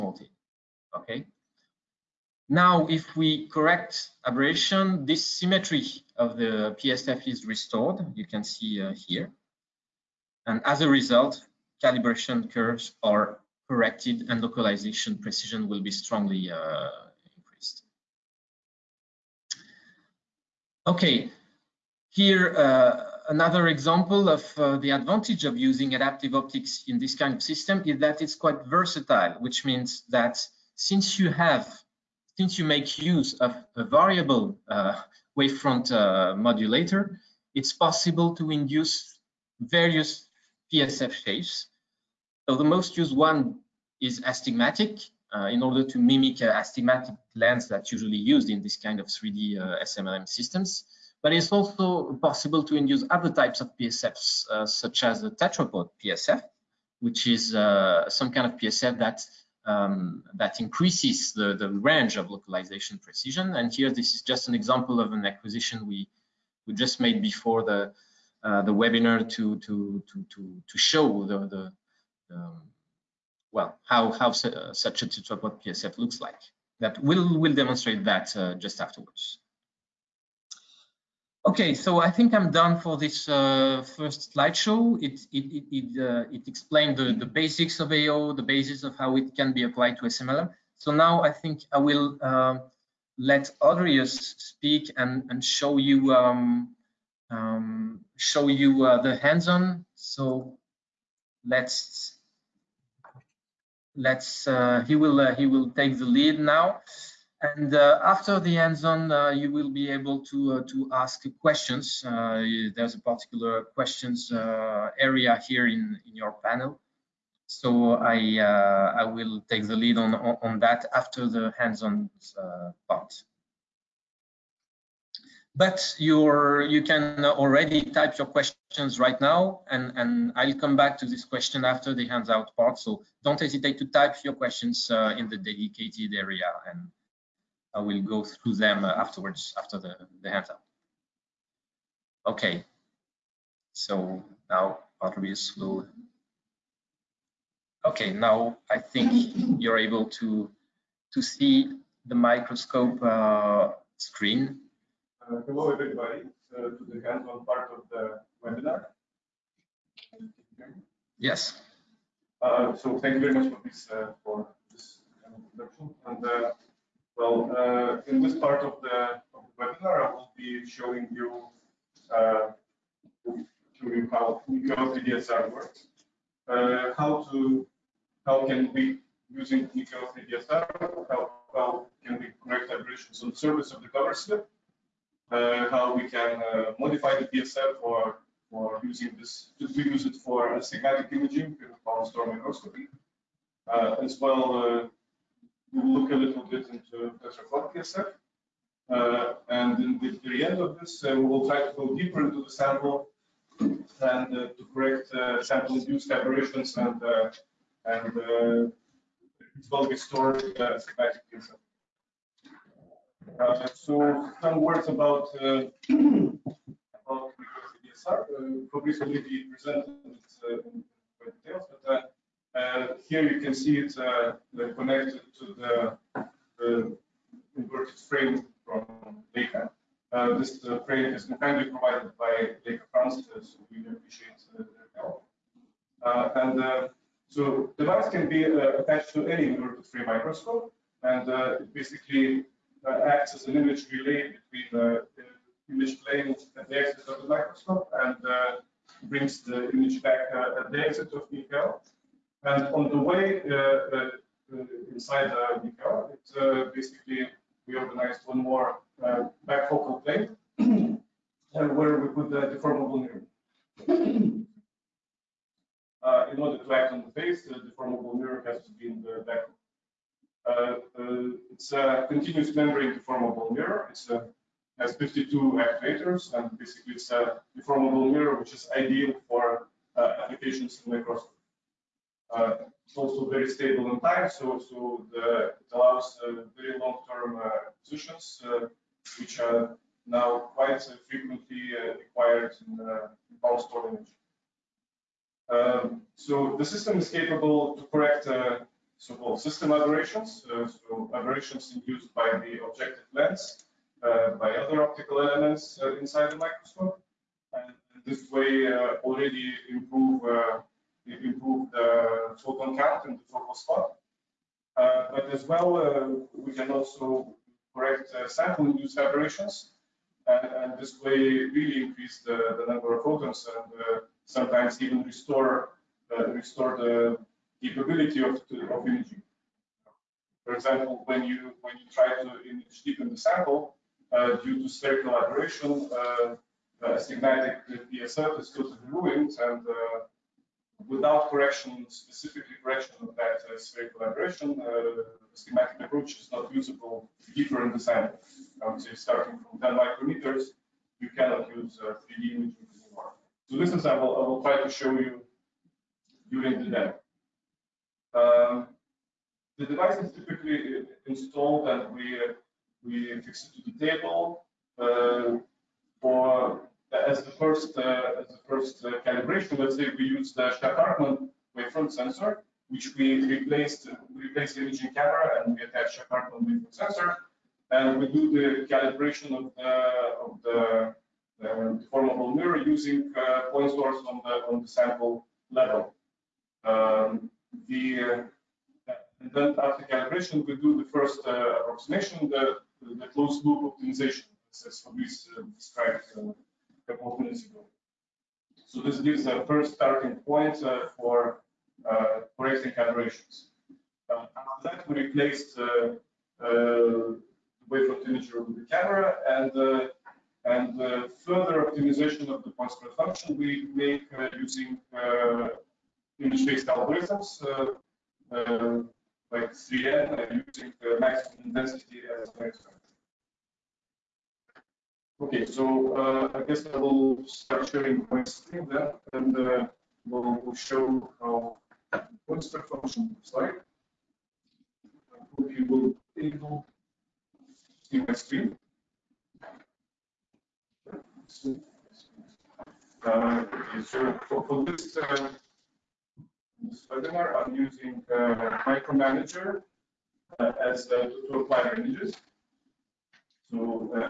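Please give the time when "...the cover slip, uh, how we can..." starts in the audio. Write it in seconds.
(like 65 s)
183 s.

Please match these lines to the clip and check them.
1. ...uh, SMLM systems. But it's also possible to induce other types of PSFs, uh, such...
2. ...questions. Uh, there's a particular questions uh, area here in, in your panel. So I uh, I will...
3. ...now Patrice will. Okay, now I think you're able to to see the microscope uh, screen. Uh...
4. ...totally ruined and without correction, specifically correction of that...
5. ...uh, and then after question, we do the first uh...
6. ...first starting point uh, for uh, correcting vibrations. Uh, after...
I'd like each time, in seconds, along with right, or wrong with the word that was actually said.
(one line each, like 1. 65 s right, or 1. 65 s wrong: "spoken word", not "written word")
1. 49 s right
2. 111 s right
3. 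144 s right
4. 338 s right
5. 388 s wrong: "calibration", not "question"
6. 399 s wrong: "aberrations", not "vibrations".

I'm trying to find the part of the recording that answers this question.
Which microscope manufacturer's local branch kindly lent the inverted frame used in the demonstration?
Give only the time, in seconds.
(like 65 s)
232 s.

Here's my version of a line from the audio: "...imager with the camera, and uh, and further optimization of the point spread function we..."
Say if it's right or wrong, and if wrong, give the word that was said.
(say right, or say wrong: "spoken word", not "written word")
right.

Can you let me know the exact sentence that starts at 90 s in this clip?
So now I think I will uh, let Audrius speak and and show you um, um, show you uh, the hands-on.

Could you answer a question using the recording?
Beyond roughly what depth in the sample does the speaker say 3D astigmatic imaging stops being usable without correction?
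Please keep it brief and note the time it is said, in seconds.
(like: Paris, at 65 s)
10 micrometers, at 349 s.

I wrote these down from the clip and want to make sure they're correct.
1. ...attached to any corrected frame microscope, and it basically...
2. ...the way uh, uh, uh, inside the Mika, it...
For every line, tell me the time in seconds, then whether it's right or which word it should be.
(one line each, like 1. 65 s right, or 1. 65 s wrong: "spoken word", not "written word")
1. 238 s wrong: "inverted", not "corrected"
2. 252 s right.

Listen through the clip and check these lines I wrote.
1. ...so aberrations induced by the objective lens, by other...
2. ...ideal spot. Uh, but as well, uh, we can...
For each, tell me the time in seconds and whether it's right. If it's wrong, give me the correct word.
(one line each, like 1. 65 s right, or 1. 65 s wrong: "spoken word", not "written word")
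1. 300 s right
2. 313 s wrong: "focal", not "ideal".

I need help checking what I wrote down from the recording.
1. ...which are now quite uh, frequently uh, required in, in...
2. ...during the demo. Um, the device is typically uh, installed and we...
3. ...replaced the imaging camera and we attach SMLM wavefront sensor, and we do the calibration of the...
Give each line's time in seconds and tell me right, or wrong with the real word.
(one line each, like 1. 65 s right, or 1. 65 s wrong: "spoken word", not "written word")
1. 289 s right
2. 356 s right
3. 374 s wrong: "Shack", not "SMLM".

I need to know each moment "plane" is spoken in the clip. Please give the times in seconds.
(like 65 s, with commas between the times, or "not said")
246 s.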